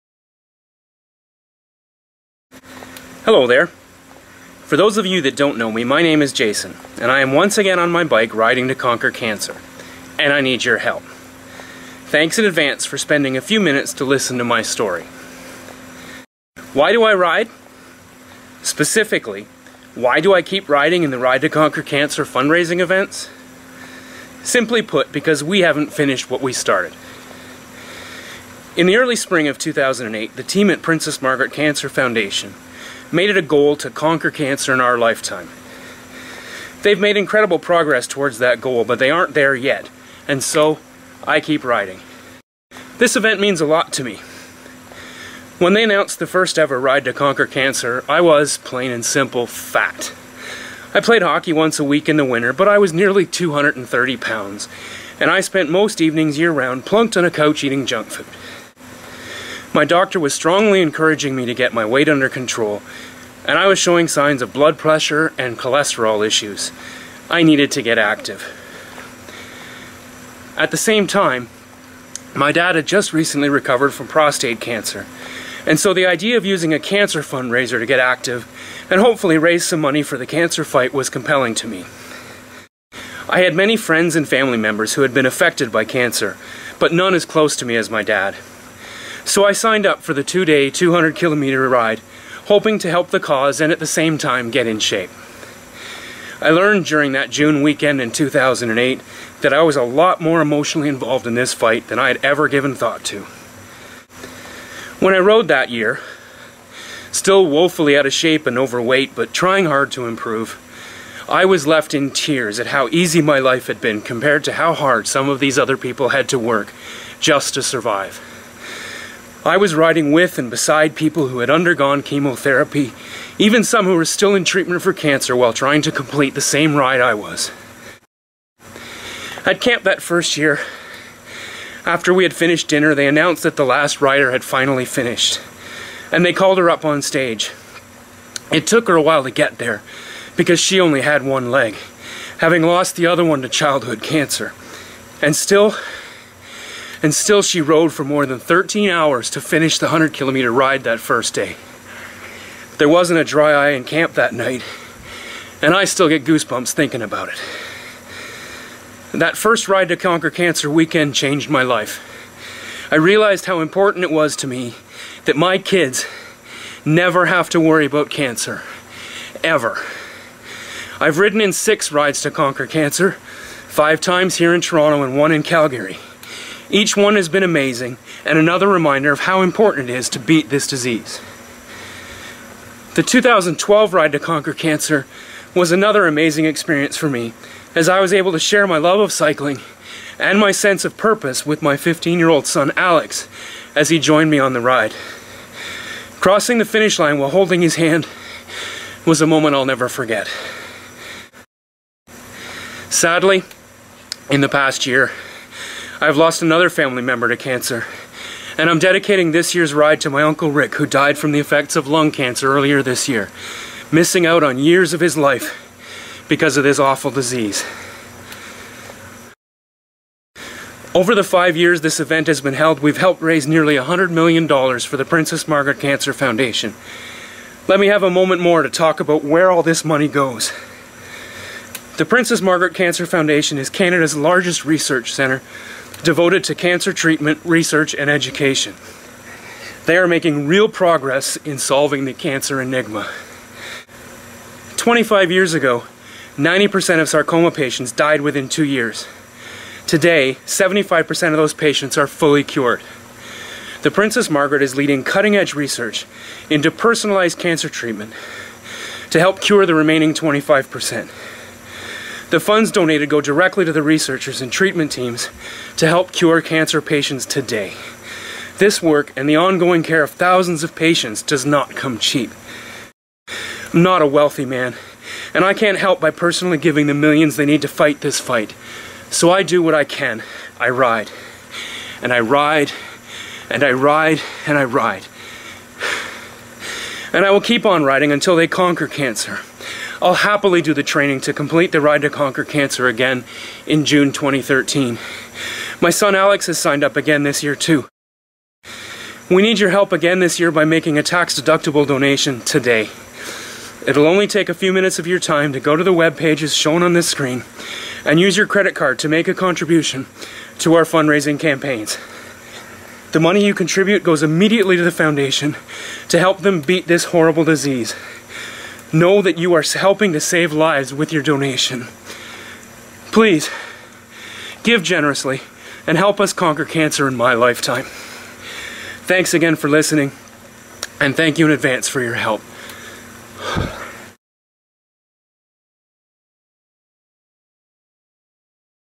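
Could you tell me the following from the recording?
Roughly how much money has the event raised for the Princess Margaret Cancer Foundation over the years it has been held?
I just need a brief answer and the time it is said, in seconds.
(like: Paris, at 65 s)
$100 million, at 223 s.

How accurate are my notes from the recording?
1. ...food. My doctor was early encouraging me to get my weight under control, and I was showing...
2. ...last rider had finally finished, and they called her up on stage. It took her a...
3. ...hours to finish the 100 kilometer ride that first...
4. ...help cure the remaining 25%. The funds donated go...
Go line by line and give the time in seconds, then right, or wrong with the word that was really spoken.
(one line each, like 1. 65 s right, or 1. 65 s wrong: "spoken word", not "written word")
1. 58 s wrong: "strongly", not "early"
2. 133 s right
3. 148 s right
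4. 259 s right.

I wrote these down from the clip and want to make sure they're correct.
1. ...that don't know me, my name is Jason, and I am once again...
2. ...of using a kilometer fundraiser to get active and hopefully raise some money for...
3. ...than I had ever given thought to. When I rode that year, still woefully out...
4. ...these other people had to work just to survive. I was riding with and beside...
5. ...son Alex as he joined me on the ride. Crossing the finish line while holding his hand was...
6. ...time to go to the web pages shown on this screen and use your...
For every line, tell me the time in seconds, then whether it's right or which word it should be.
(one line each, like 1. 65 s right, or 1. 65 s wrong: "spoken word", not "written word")
1. 5 s right
2. 76 s wrong: "cancer", not "kilometer"
3. 101 s right
4. 115 s right
5. 192 s right
6. 305 s right.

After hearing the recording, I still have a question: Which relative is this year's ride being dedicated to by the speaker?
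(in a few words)
Uncle Rick.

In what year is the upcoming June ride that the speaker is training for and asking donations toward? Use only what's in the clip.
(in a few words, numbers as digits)
2013.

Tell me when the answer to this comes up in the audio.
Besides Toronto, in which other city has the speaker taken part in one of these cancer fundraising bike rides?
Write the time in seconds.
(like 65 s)
175 s.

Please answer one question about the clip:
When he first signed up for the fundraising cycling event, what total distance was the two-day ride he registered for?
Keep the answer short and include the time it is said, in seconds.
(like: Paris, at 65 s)
200 kilometers, at 90 s.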